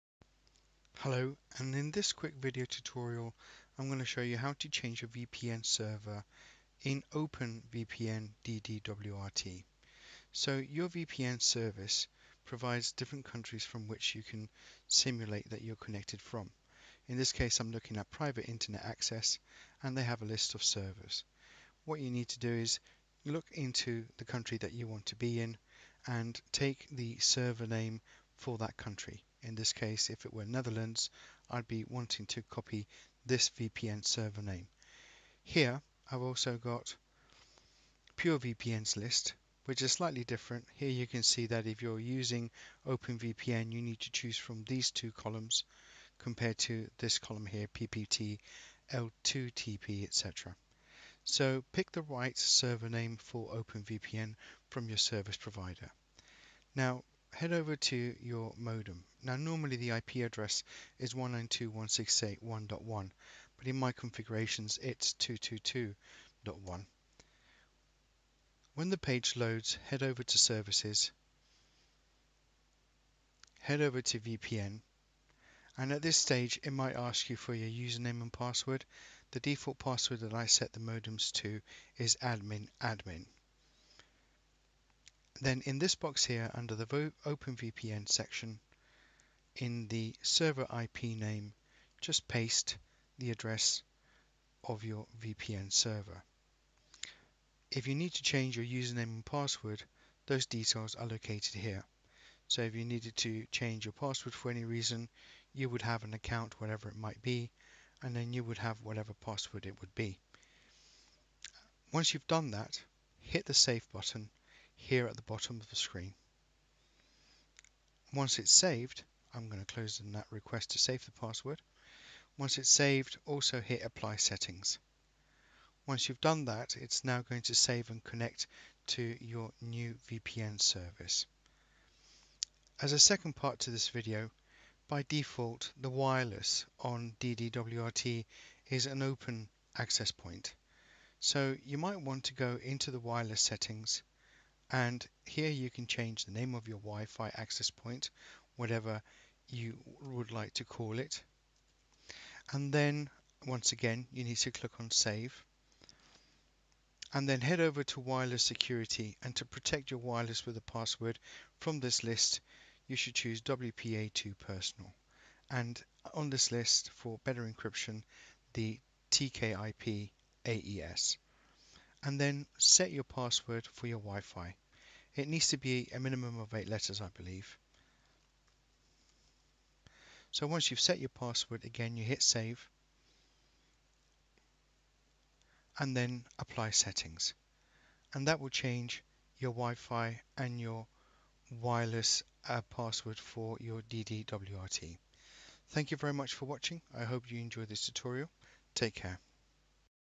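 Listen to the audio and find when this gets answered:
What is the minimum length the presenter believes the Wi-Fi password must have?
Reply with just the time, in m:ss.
2:56.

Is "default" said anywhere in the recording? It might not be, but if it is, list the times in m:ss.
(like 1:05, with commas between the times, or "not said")
1:19, 2:15.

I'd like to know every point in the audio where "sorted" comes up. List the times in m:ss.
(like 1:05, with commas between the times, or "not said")
not said.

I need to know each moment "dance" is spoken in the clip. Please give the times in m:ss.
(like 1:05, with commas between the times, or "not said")
not said.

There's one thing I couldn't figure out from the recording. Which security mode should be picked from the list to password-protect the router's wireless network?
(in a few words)
WPA2 Personal.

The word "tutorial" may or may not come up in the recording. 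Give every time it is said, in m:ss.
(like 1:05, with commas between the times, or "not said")
0:02, 3:17.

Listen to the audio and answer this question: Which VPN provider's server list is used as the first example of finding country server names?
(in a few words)
Private Internet Access.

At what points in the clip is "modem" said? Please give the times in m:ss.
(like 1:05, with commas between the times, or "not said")
0:58, 1:20.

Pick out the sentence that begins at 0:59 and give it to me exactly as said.
Now normally the IP address is 192.168.1.1 but in my configurations it's 222.1.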